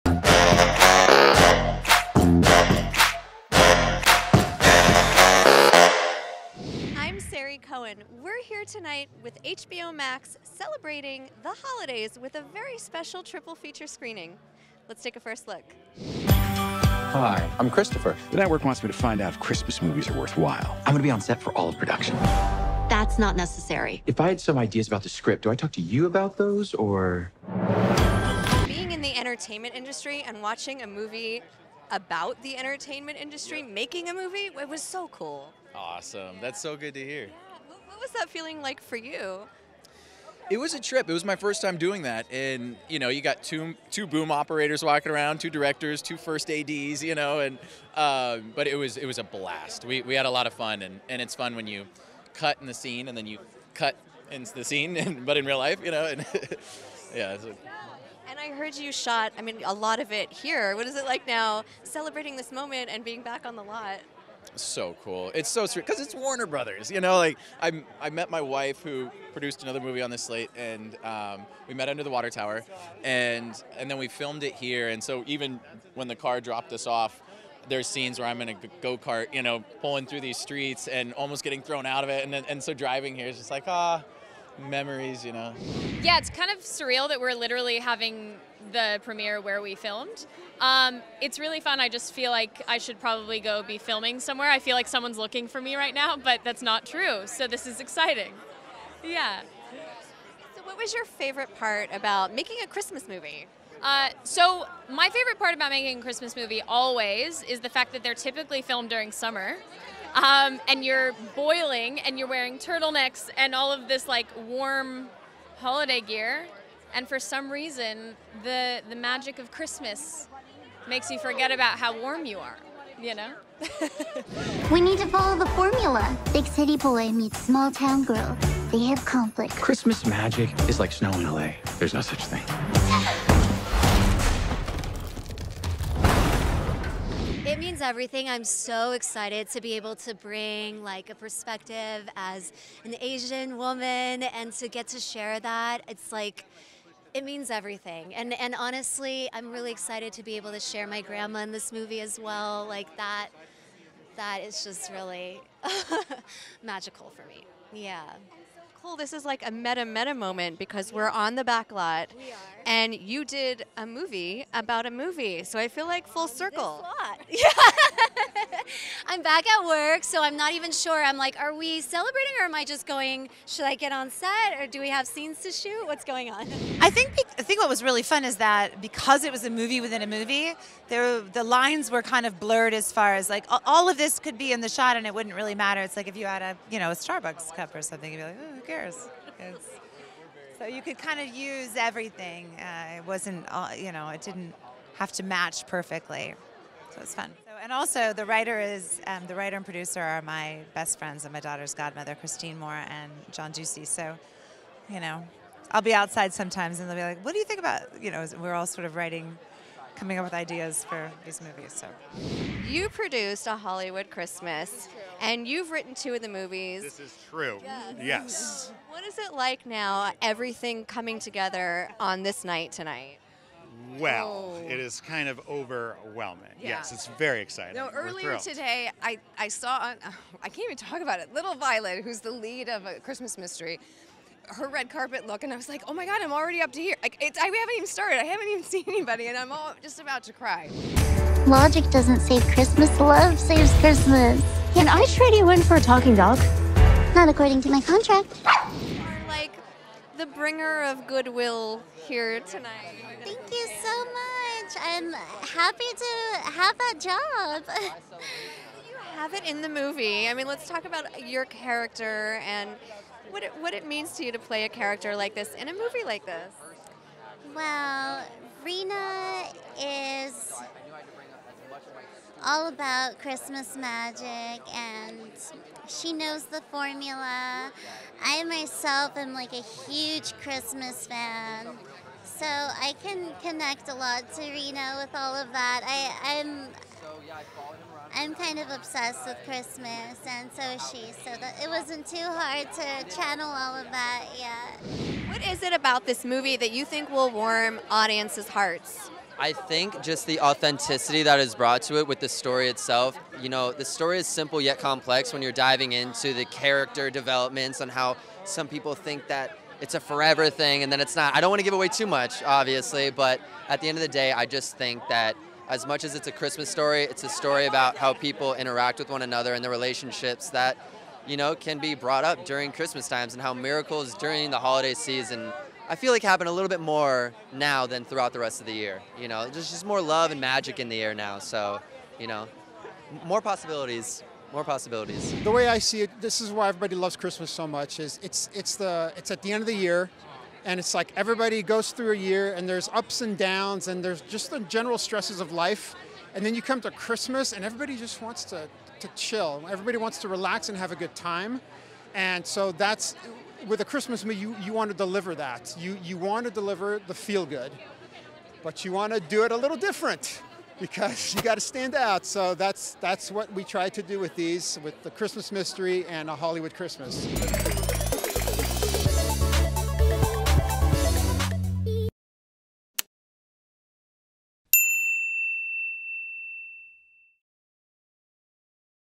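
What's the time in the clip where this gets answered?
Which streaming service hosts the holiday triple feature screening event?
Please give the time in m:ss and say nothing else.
0:09.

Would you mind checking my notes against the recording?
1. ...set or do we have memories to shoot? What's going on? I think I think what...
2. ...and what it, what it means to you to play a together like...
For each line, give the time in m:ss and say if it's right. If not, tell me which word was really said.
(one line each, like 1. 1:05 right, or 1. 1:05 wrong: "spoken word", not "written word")
1. 2:54 wrong: "scenes", not "memories"
2. 4:22 wrong: "character", not "together".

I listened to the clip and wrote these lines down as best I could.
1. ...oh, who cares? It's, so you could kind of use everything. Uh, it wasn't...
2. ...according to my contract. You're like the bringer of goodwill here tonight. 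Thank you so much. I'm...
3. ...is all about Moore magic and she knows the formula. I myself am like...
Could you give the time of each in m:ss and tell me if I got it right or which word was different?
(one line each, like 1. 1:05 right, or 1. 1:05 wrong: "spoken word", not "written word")
1. 3:08 right
2. 4:07 right
3. 4:29 wrong: "Christmas", not "Moore".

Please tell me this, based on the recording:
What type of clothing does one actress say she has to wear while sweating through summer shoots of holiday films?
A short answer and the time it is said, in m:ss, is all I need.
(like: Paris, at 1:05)
turtlenecks, at 1:52.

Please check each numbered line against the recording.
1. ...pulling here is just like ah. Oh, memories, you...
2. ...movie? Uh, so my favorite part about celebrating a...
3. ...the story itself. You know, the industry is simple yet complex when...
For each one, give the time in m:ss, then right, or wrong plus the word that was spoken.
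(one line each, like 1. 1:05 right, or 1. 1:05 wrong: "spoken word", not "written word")
1. 1:22 wrong: "driving", not "pulling"
2. 1:43 wrong: "making", not "celebrating"
3. 5:02 wrong: "story", not "industry".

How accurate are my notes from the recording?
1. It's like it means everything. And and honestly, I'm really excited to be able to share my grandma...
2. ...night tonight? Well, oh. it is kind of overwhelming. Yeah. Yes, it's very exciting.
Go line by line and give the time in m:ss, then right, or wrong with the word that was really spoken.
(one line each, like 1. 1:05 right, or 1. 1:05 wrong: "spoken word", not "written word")
1. 2:25 right
2. 3:42 right.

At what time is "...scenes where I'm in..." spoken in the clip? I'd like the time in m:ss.
1:17.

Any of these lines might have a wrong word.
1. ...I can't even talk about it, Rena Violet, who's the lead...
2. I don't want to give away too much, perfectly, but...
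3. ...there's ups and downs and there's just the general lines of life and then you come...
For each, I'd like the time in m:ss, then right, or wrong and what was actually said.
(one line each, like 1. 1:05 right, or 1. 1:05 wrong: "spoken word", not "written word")
1. 3:50 wrong: "Little", not "Rena"
2. 5:11 wrong: "obviously", not "perfectly"
3. 5:42 wrong: "stresses", not "lines".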